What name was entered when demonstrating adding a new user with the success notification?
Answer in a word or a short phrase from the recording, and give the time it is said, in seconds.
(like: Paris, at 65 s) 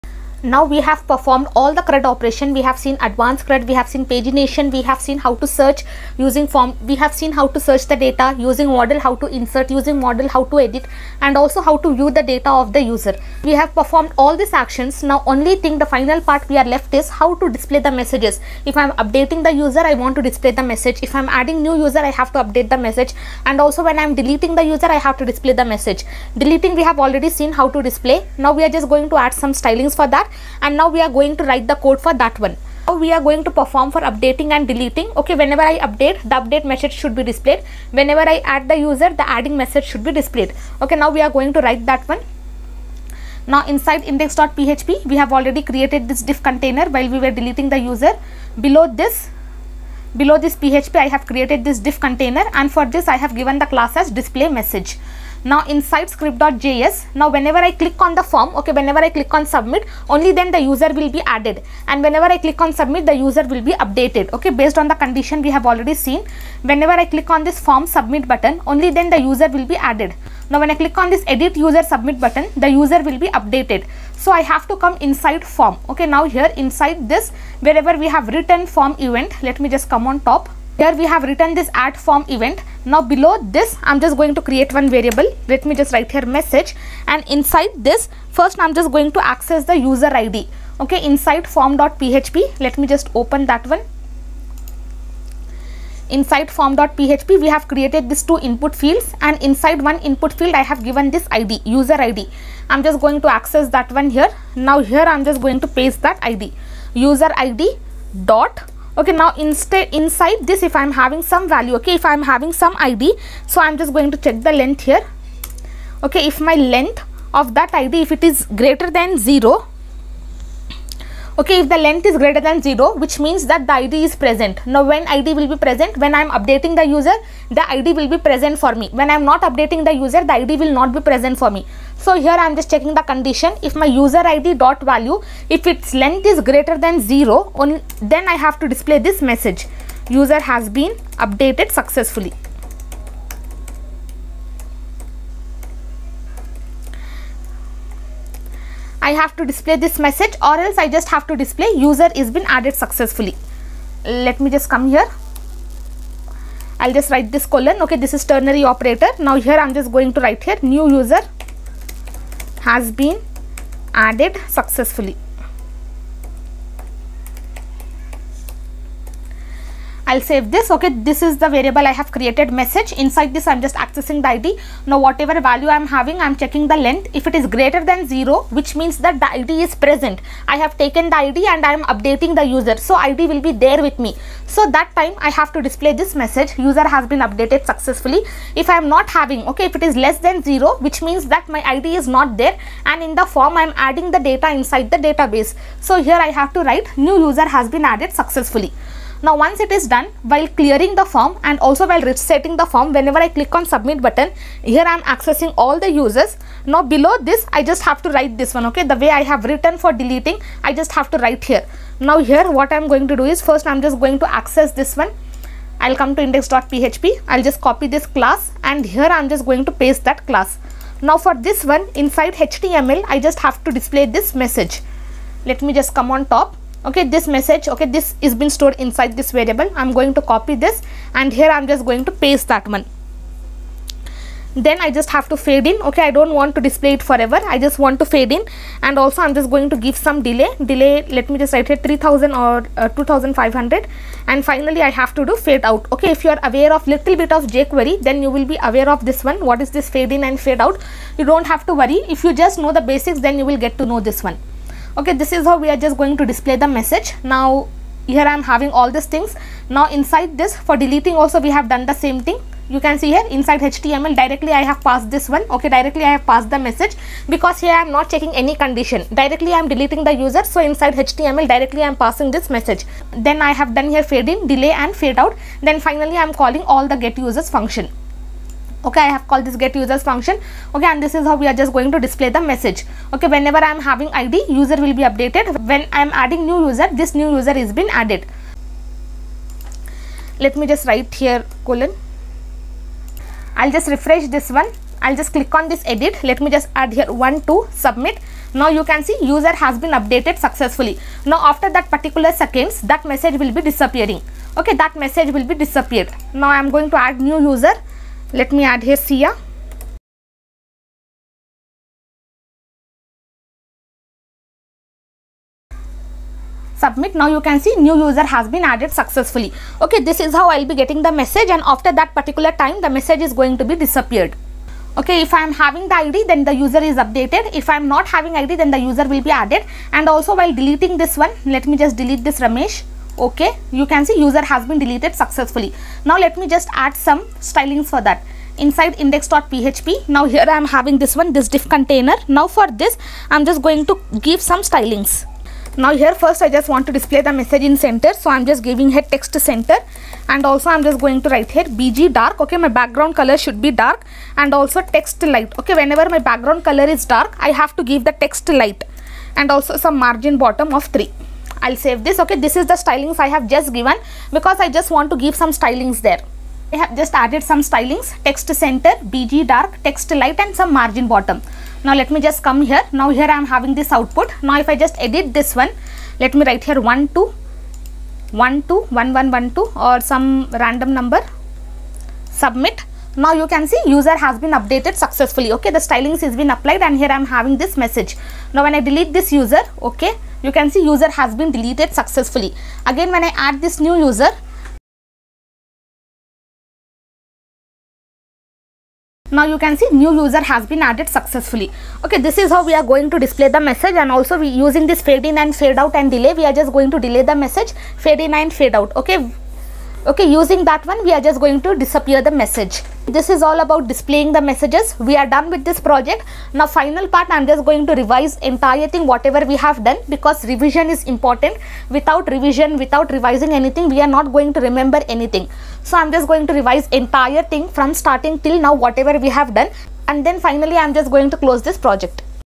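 Sia, at 308 s.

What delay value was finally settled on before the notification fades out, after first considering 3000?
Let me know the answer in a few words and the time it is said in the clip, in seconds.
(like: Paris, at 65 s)
2500, at 242 s.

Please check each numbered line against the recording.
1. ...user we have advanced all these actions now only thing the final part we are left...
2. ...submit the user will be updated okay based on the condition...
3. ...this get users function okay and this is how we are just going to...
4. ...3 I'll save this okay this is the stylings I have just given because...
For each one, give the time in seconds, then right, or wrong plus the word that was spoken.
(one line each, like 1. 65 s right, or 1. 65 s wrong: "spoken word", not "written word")
1. 12 s wrong: "performed", not "advanced"
2. 62 s right
3. 279 s right
4. 360 s right.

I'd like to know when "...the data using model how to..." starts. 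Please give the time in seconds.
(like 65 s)
7 s.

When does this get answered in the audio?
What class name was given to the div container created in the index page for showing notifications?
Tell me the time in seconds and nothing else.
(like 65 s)
54 s.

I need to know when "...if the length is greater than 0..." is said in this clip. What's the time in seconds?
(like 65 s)
121 s.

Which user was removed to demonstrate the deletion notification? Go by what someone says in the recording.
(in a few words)
Ramesh.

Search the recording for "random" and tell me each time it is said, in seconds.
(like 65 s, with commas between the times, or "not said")
380 s.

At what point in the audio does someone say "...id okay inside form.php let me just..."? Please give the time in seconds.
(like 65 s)
90 s.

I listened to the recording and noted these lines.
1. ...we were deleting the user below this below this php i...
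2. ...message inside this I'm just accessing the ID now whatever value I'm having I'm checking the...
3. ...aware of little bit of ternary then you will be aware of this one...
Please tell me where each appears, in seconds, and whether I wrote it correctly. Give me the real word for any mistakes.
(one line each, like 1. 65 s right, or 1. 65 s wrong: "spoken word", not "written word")
1. 47 s right
2. 172 s right
3. 246 s wrong: "jquery", not "ternary".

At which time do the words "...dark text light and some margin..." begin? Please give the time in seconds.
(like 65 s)
369 s.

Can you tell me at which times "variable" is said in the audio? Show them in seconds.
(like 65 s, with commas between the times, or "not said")
84 s, 171 s, 229 s.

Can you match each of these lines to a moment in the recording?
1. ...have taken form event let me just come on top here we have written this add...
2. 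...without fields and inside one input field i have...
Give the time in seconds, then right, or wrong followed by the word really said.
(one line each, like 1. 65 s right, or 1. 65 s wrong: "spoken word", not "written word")
1. 78 s wrong: "written", not "taken"
2. 98 s wrong: "input", not "without".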